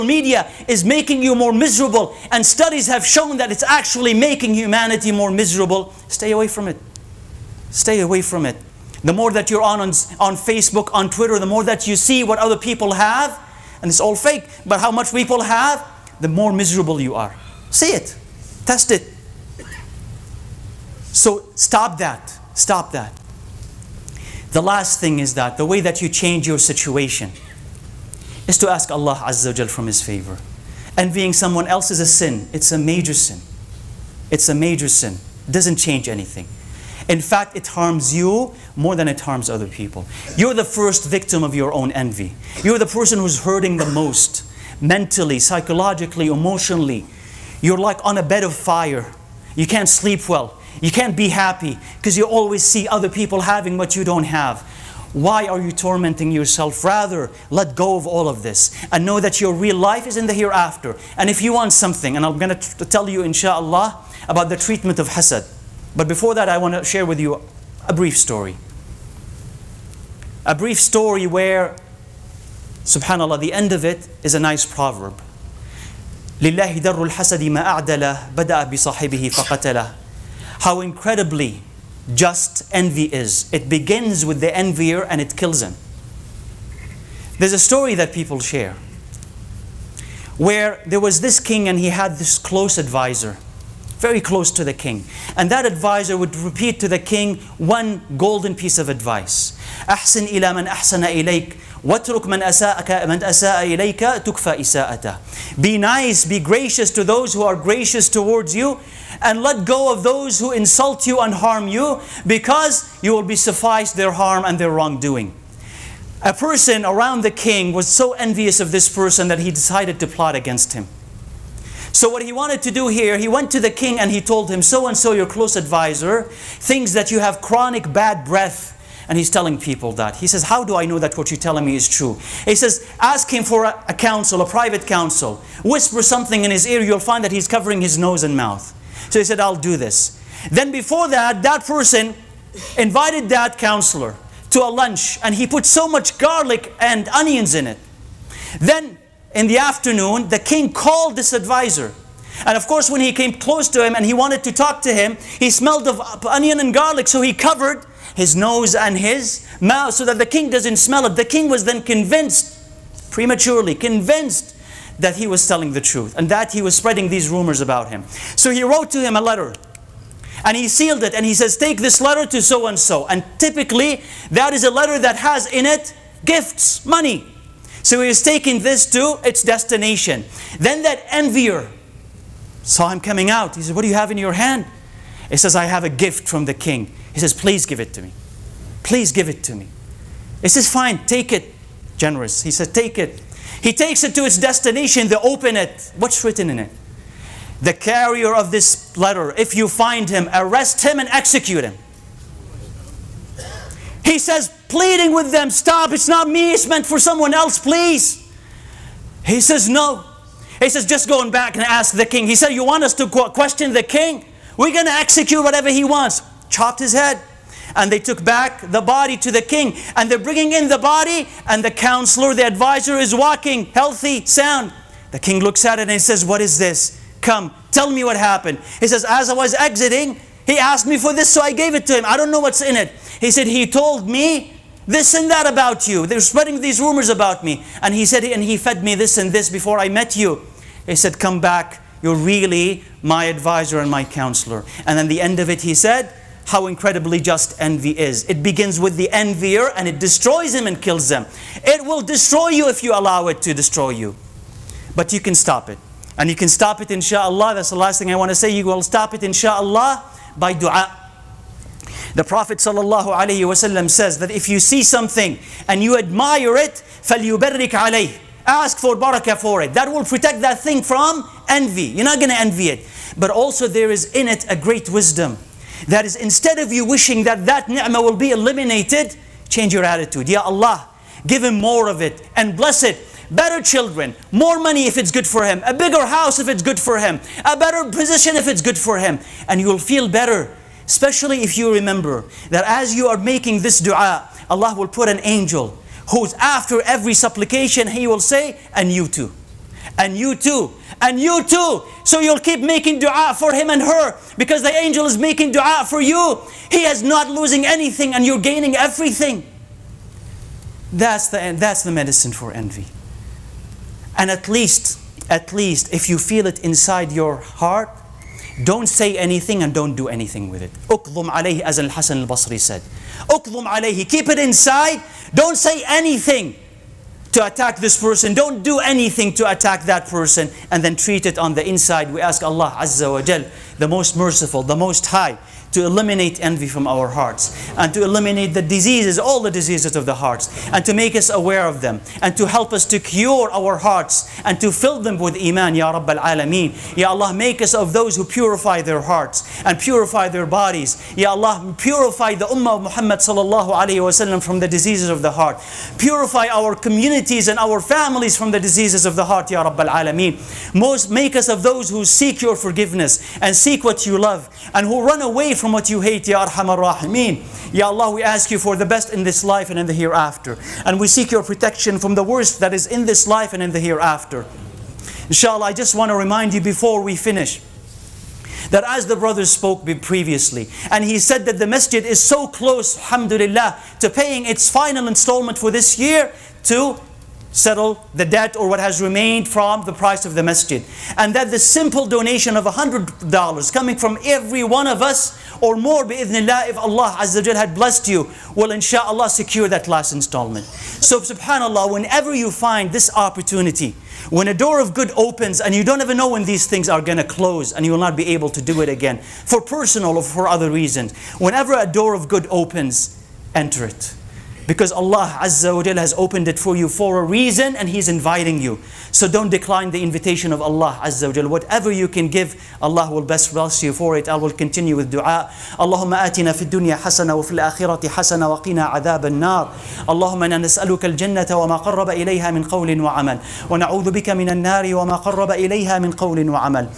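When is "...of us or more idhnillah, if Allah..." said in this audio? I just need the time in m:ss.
6:34.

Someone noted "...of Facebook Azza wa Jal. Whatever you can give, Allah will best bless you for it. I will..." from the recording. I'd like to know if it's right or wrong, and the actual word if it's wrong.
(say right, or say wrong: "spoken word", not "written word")
wrong: "Allah", not "Facebook".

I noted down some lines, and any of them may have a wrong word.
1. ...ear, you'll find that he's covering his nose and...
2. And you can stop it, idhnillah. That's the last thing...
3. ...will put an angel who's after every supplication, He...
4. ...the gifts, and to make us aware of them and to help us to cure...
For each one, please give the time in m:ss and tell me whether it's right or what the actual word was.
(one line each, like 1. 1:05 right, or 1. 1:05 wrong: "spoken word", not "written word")
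1. 2:16 right
2. 4:16 wrong: "inshallah", not "idhnillah"
3. 4:54 right
4. 5:40 wrong: "hearts", not "gifts".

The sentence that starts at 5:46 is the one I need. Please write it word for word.
Ya Allah, make us of those who purify their hearts and purify their bodies.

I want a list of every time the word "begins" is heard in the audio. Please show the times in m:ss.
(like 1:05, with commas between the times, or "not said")
1:23, 4:08.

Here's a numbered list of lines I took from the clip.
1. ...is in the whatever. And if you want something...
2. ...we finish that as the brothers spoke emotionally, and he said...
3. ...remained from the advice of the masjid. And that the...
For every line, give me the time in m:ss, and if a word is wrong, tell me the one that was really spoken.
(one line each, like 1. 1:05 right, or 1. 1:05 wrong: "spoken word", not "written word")
1. 1:00 wrong: "hereafter", not "whatever"
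2. 6:17 wrong: "previously", not "emotionally"
3. 6:29 wrong: "price", not "advice".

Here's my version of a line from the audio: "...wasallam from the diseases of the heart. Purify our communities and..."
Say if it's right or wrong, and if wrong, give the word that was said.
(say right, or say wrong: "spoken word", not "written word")
right.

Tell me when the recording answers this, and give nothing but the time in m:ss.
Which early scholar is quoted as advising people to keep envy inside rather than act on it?
5:21.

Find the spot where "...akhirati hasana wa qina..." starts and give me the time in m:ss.
7:07.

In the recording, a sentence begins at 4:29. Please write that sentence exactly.
That will protect that thing from envy.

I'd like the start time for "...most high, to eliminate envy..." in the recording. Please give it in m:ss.
5:34.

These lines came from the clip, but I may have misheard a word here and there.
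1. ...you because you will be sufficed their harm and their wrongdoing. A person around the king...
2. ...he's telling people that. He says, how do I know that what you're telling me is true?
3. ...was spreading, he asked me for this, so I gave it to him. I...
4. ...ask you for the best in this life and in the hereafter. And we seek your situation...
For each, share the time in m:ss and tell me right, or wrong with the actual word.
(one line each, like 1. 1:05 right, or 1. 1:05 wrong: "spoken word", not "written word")
1. 1:51 right
2. 2:09 right
3. 3:49 wrong: "exiting", not "spreading"
4. 6:08 wrong: "protection", not "situation".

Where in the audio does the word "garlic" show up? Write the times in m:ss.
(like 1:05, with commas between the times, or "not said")
2:26, 2:36.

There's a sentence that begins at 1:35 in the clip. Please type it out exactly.
And that advisor would repeat to the king one golden piece of advice.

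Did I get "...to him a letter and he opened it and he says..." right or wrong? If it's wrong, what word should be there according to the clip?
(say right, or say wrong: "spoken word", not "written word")
wrong: "sealed", not "opened".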